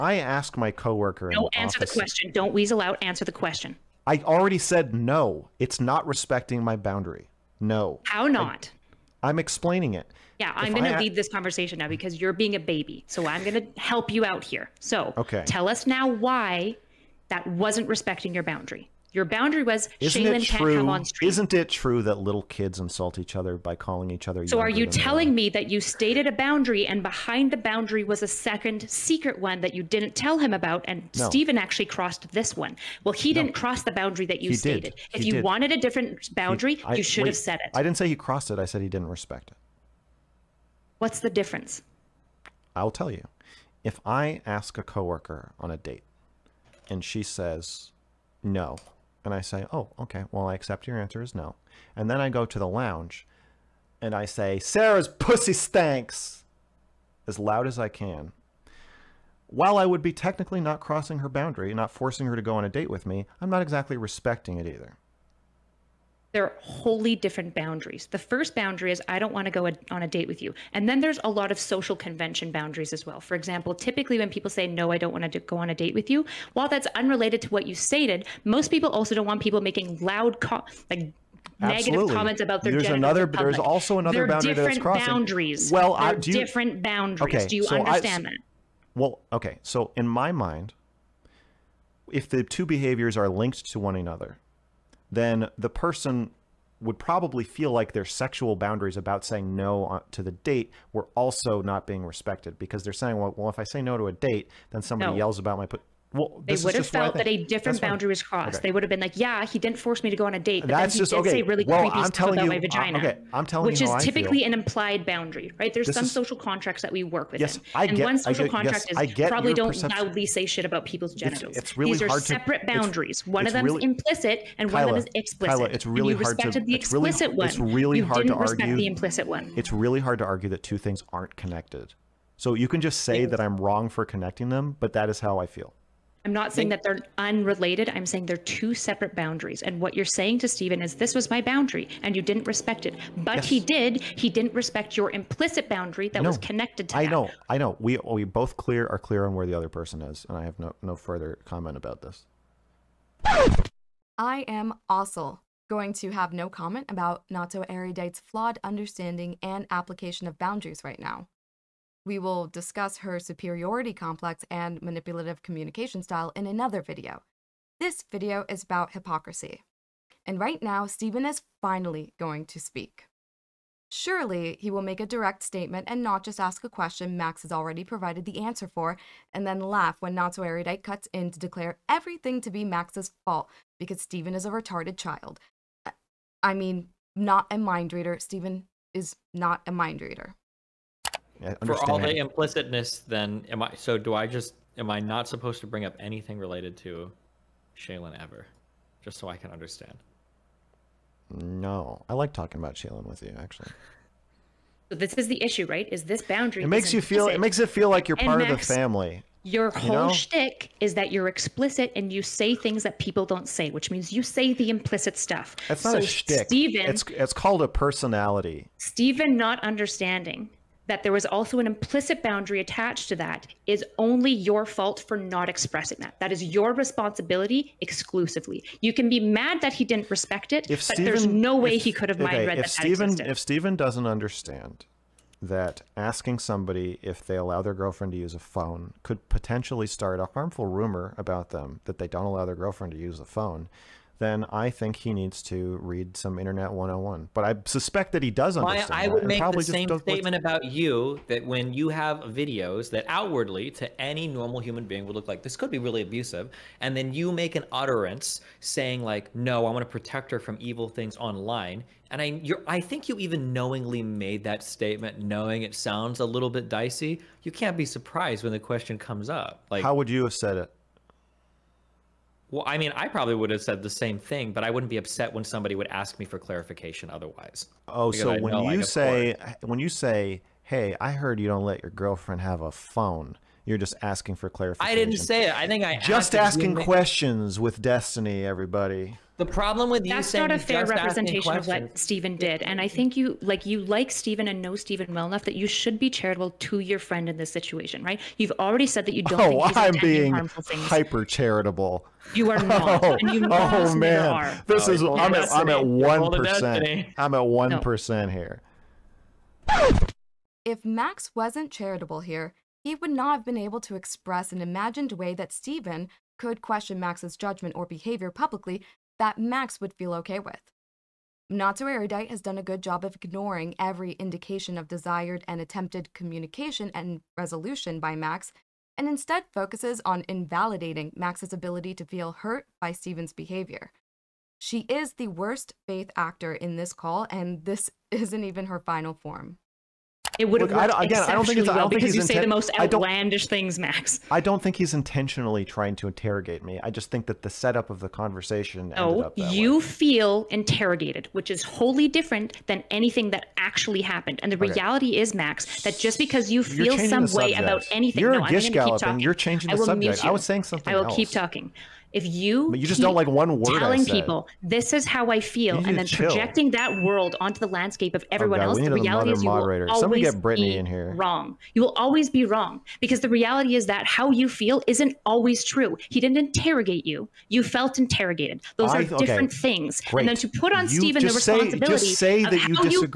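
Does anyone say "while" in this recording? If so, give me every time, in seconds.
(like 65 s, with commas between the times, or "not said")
59 s, 76 s.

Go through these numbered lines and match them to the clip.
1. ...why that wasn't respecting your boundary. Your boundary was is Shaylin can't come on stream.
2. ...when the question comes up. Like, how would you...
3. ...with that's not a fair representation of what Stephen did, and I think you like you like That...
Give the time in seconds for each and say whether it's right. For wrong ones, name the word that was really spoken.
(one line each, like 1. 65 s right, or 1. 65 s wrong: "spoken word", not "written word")
1. 16 s right
2. 268 s right
3. 289 s wrong: "Stephen", not "That".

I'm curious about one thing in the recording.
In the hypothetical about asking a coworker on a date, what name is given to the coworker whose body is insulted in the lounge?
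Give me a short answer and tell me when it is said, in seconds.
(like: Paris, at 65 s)
Sarah, at 54 s.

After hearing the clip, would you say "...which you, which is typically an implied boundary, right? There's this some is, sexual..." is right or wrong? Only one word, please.
wrong.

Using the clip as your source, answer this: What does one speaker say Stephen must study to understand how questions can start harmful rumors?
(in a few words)
Internet 101.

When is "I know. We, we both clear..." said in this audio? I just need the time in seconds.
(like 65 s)
147 s.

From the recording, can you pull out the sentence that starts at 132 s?
So you can just say that I'm wrong for connecting them, but that is how I feel.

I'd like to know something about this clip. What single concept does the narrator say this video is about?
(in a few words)
Hypocrisy.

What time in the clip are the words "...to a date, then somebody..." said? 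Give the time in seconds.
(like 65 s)
103 s.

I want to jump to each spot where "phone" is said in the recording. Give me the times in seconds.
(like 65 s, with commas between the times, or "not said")
238 s, 243 s, 282 s.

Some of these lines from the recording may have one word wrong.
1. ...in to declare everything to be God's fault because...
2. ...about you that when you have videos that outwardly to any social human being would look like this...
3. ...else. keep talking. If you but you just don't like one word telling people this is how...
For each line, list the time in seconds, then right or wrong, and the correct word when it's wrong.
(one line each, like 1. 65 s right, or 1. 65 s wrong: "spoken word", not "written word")
1. 181 s wrong: "Max", not "God"
2. 250 s wrong: "normal", not "social"
3. 361 s right.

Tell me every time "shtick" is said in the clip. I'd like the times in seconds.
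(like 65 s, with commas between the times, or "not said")
210 s, 216 s.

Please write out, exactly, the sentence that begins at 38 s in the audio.
I said he didn't respect it.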